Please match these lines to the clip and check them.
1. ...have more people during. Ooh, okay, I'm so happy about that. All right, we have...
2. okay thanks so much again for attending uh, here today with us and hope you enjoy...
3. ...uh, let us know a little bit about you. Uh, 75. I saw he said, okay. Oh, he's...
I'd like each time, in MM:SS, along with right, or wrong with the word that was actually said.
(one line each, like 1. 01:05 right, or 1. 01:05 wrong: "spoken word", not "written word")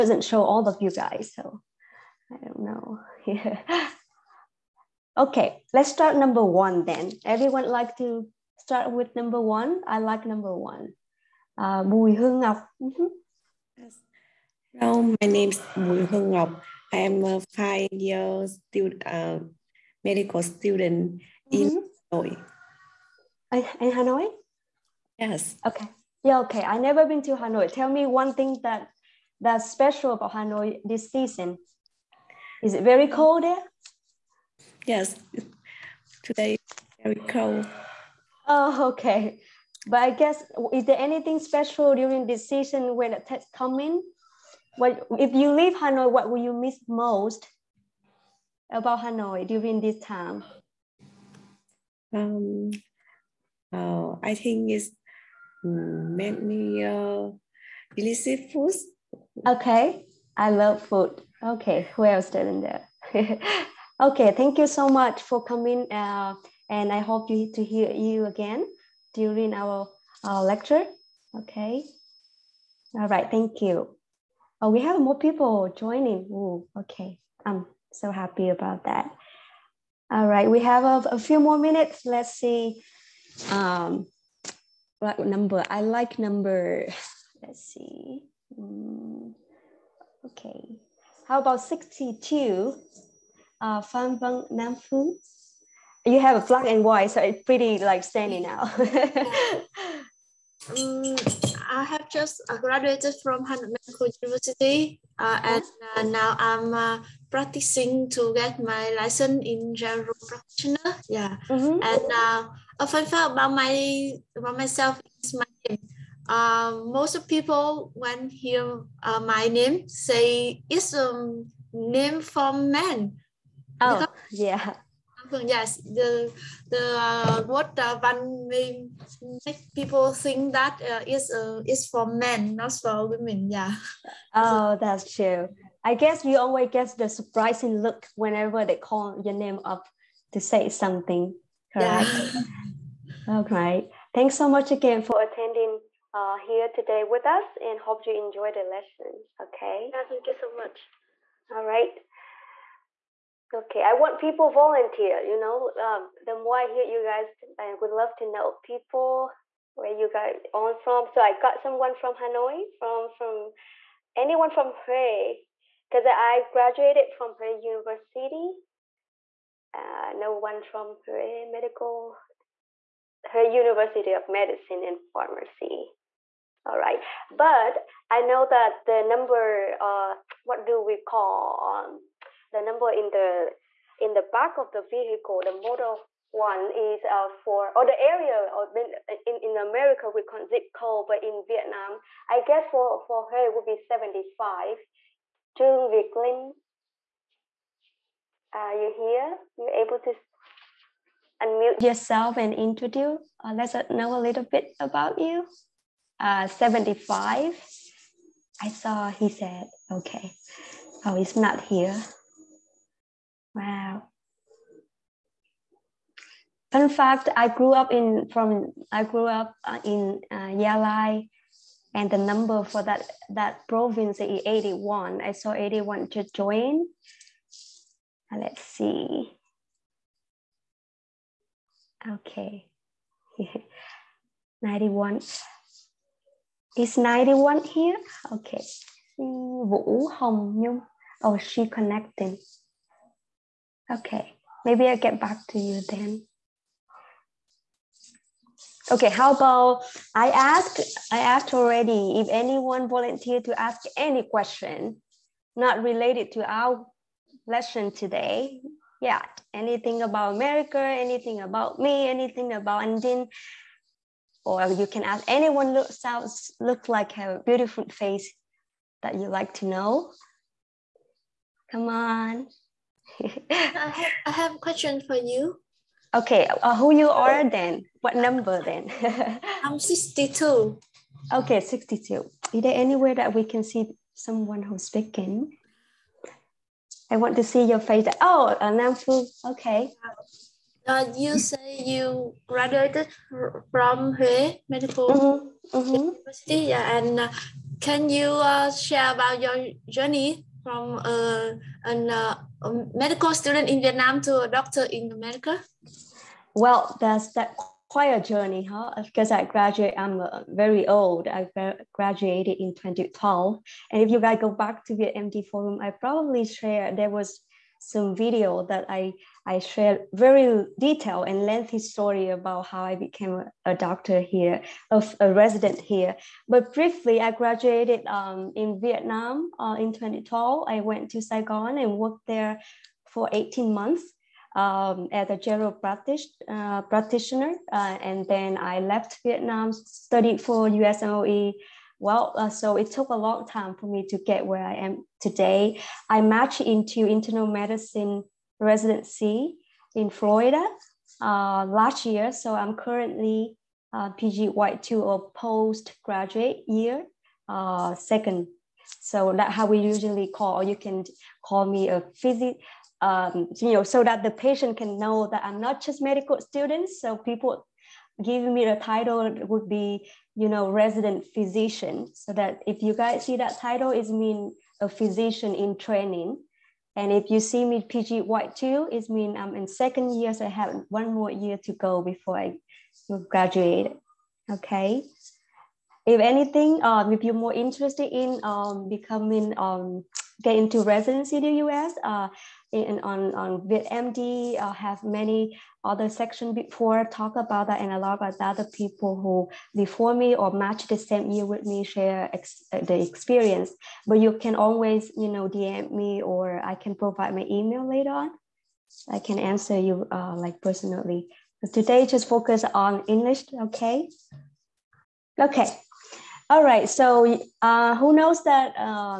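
1. 01:14 wrong: "joining", not "during"
2. 02:23 right
3. 03:23 right.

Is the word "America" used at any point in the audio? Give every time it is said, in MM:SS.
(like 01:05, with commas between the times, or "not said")
03:09, 04:20, 05:05.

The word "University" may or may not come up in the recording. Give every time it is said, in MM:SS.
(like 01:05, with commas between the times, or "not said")
01:44, 02:47, 02:53, 04:56.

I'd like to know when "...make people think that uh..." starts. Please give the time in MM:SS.
02:09.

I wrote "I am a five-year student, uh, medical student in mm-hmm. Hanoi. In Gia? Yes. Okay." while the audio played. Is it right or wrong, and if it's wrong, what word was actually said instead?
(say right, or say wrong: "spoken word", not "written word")
wrong: "Hanoi", not "Gia".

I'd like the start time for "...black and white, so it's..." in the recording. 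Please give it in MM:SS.
01:36.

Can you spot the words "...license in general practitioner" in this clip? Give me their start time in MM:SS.
01:48.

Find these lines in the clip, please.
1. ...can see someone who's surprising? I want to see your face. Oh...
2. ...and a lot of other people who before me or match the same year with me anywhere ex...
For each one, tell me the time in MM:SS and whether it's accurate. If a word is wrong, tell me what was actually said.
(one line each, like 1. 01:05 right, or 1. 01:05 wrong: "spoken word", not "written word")
1. 04:43 wrong: "speaking", not "surprising"
2. 06:37 wrong: "share", not "anywhere".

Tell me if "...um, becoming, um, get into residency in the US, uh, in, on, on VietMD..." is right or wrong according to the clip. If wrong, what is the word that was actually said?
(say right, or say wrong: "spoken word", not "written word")
right.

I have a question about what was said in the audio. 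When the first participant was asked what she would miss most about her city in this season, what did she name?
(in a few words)
Delicious foods.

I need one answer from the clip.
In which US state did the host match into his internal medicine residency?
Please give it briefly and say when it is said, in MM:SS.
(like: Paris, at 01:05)
Florida, at 05:50.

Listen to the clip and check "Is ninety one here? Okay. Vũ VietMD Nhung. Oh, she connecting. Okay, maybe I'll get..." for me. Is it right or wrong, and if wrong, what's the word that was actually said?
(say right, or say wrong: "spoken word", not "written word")
wrong: "Hồng", not "VietMD".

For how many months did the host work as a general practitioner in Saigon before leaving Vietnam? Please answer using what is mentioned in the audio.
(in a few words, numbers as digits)
18.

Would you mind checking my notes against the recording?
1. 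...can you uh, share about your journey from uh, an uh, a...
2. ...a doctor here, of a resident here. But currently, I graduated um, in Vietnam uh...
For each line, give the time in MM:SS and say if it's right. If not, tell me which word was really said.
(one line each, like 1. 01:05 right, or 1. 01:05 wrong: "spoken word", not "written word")
1. 04:57 right
2. 05:23 wrong: "briefly", not "currently".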